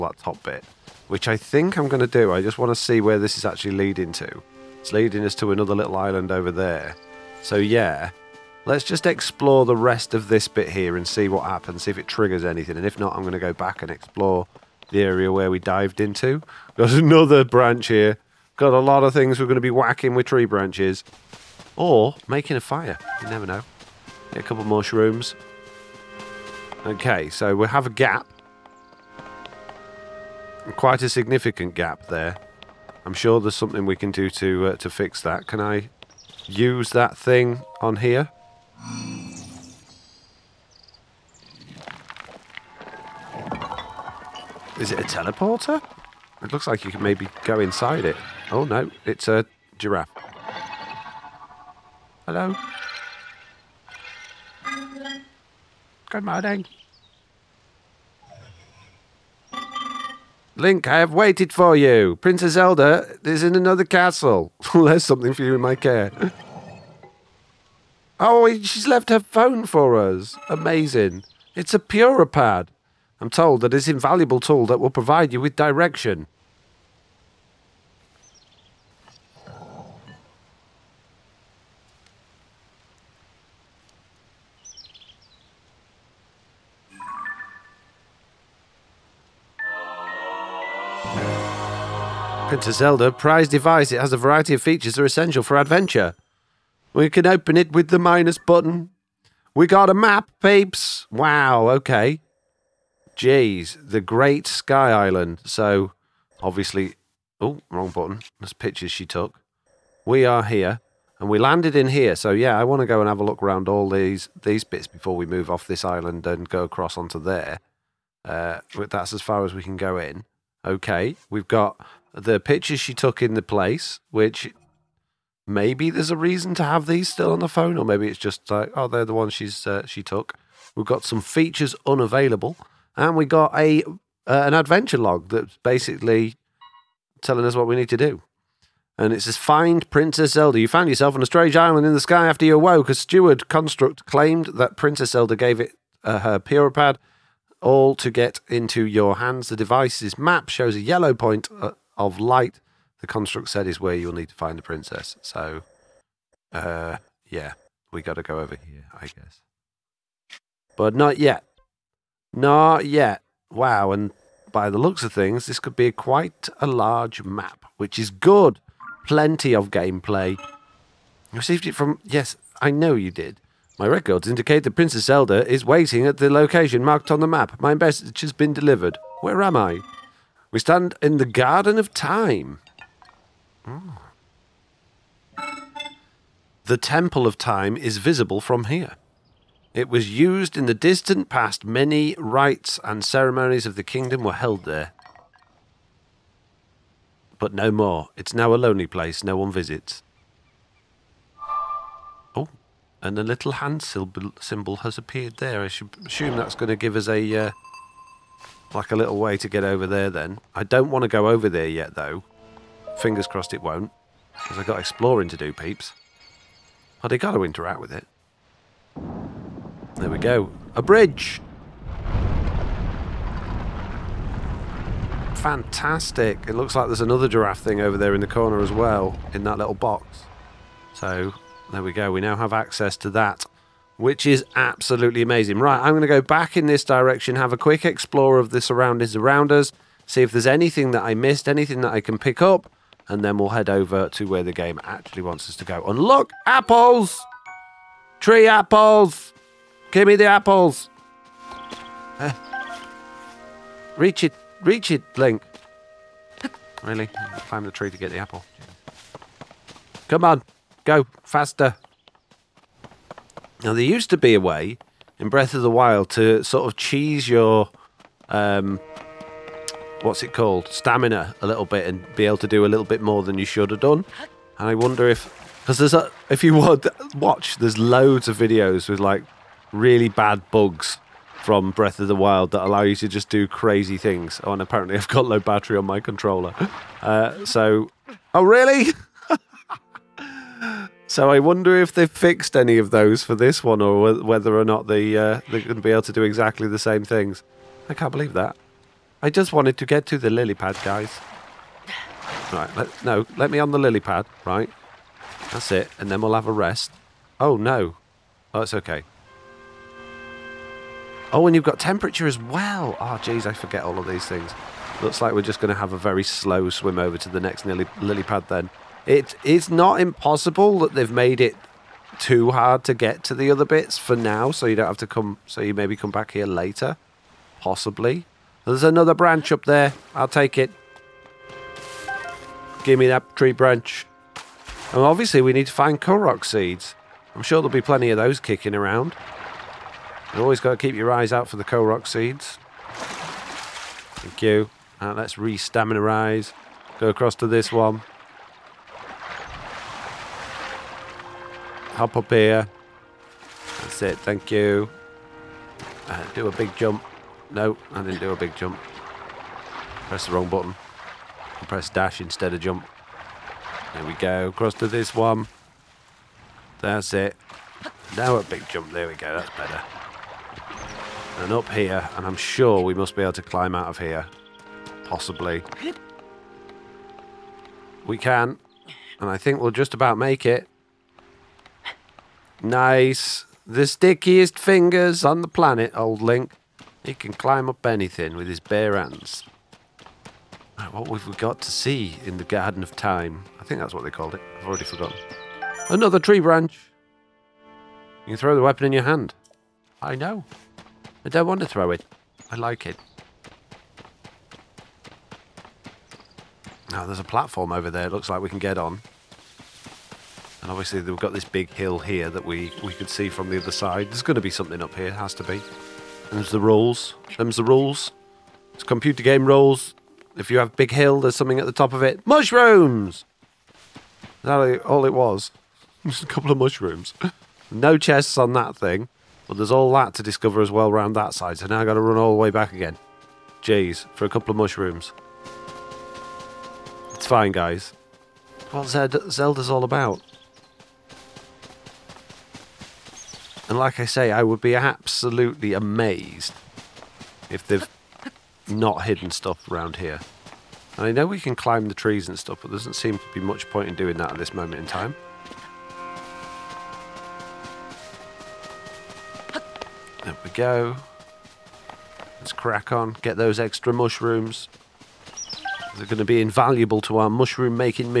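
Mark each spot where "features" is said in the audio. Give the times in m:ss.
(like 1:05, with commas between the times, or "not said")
1:34, 2:11.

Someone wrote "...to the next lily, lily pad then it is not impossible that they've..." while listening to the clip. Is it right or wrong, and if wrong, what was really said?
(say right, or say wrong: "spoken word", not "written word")
right.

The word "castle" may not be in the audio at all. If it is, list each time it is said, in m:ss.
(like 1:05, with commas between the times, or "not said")
1:03.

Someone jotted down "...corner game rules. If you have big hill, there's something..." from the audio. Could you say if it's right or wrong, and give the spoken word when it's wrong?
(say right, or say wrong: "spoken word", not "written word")
wrong: "computer", not "corner".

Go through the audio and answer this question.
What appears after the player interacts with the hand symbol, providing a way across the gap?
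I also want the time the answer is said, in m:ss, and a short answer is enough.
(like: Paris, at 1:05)
A bridge, at 3:40.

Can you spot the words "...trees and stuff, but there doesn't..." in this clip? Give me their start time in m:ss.
7:31.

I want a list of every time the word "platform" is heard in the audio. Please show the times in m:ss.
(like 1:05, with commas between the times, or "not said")
6:47.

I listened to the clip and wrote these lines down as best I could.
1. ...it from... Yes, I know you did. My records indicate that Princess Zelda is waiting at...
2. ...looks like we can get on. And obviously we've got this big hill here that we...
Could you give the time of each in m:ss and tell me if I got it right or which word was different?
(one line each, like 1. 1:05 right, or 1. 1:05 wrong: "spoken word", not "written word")
1. 2:51 right
2. 6:48 right.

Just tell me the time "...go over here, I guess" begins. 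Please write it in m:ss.
2:38.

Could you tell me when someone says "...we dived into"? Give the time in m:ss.
0:15.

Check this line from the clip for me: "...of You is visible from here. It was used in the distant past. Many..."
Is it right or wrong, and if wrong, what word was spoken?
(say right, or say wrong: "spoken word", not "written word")
wrong: "Time", not "You".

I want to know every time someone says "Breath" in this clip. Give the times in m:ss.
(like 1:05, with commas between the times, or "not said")
4:25, 4:41.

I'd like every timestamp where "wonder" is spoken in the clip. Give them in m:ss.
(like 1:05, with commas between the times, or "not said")
4:34, 4:51.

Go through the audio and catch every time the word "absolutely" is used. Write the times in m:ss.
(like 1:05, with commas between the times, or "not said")
3:54, 7:24.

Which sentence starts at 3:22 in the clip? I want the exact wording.
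Oh, and a little hand symbol has appeared there.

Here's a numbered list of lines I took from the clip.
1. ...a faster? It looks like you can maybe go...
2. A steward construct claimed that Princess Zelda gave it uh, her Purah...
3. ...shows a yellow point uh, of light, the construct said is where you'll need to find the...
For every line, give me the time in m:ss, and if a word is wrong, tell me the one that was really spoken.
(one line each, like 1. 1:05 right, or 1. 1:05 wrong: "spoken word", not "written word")
1. 0:44 wrong: "teleporter", not "faster"
2. 2:22 right
3. 2:30 right.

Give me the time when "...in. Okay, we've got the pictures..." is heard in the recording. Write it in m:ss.
1:59.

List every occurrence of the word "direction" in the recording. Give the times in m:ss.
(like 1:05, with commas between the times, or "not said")
1:15, 3:56.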